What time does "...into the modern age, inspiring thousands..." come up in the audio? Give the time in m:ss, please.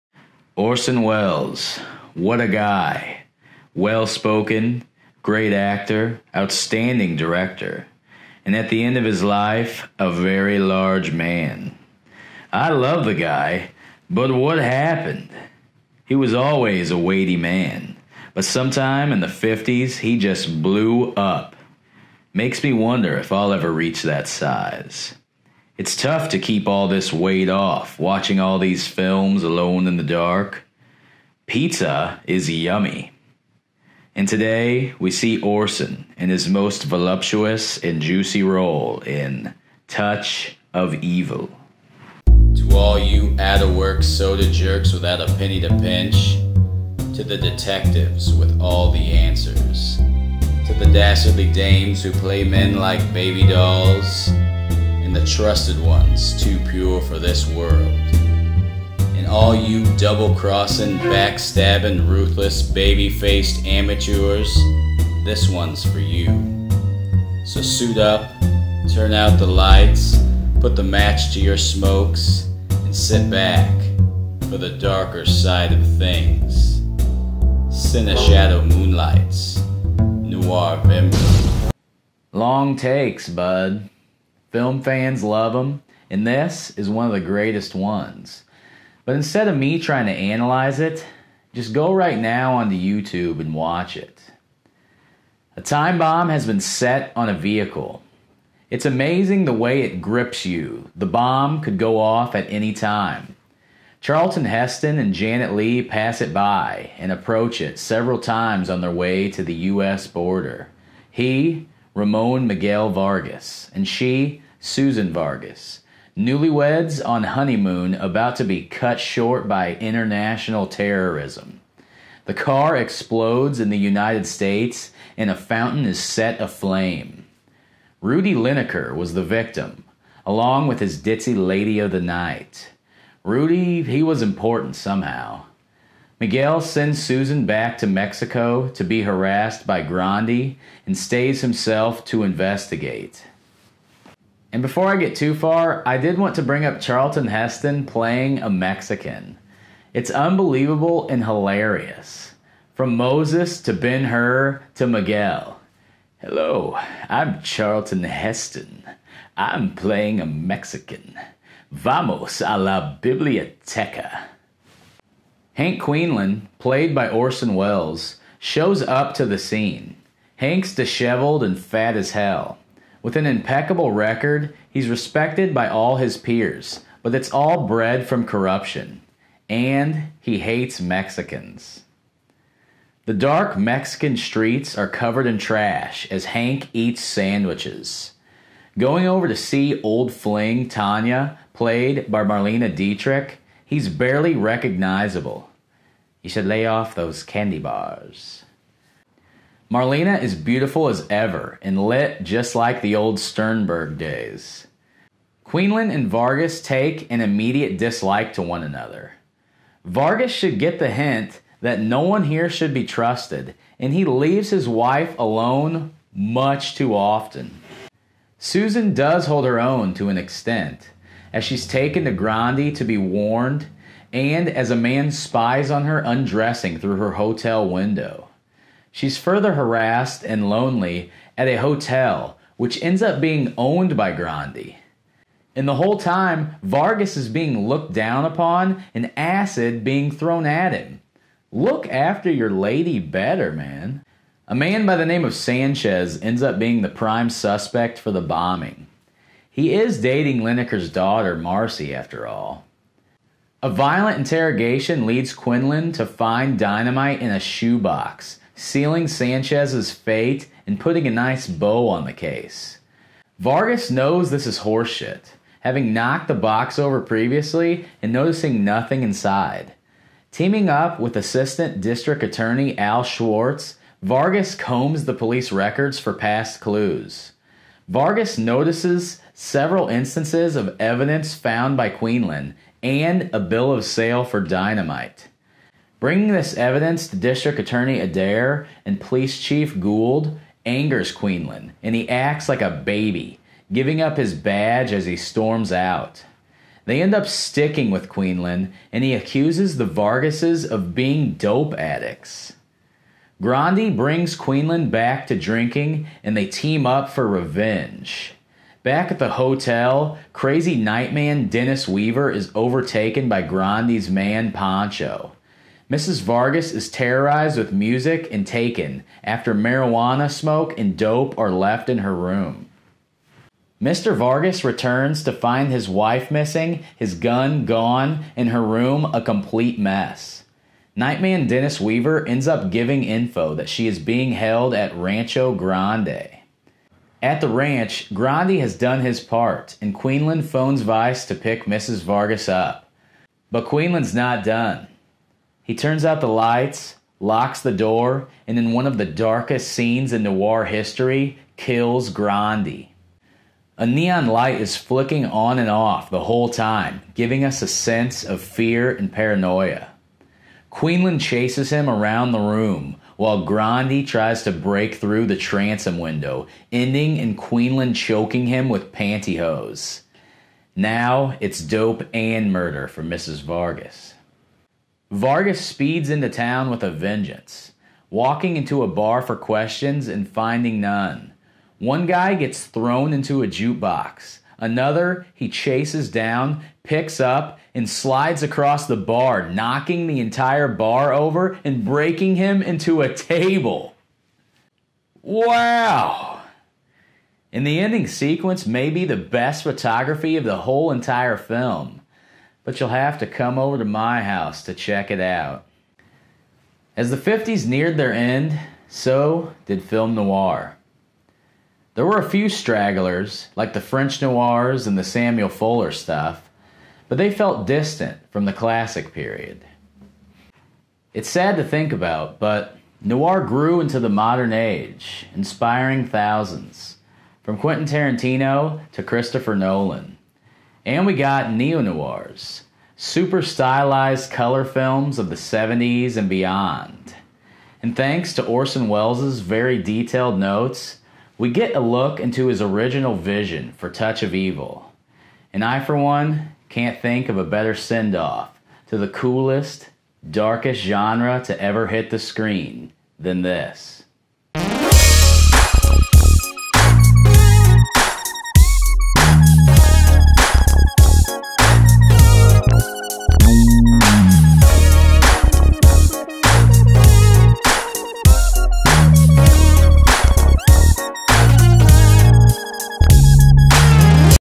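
7:03.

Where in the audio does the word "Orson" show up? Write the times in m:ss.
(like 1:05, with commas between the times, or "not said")
0:00, 0:35, 2:47, 7:18.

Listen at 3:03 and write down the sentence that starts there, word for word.
The dark Mexican streets are covered in trash as Hank eats sandwiches.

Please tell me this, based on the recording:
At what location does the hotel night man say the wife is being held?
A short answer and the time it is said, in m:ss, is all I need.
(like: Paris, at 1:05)
Rancho Grande, at 5:34.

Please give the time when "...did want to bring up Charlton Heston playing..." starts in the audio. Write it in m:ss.
2:25.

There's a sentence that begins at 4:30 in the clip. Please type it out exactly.
Teaming up with Assistant District Attorney Al Schwartz, Vargas combs the police records for past clues.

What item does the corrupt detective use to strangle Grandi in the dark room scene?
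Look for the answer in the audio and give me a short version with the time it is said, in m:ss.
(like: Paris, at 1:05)
Pantyhose, at 6:08.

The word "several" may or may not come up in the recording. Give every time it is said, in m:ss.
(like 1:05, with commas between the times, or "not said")
1:47, 4:39.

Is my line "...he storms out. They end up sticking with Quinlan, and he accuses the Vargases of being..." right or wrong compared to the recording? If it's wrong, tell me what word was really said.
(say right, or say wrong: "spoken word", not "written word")
right.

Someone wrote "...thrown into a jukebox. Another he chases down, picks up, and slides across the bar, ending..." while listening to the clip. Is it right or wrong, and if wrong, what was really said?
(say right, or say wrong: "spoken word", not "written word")
wrong: "knocking", not "ending".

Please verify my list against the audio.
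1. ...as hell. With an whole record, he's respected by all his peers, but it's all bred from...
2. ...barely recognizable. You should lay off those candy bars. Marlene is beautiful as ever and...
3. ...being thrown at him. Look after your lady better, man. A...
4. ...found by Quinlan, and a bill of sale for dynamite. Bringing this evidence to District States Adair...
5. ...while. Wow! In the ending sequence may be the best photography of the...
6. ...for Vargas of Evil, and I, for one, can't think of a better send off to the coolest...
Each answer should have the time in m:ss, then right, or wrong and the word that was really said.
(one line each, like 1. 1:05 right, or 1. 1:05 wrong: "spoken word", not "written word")
1. 2:51 wrong: "impeccable", not "whole"
2. 3:13 right
3. 3:59 right
4. 4:41 wrong: "Attorney", not "States"
5. 6:33 wrong: "table", not "while"
6. 7:23 wrong: "Touch", not "Vargas".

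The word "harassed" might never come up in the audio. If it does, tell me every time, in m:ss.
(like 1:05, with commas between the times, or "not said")
2:19, 3:49.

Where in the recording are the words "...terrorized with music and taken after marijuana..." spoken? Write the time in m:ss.
5:16.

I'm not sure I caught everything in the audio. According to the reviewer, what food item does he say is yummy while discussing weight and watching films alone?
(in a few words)
Pizza.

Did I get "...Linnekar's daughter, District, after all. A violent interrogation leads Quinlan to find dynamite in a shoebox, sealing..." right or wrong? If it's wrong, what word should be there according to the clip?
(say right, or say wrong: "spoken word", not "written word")
wrong: "Marcy", not "District".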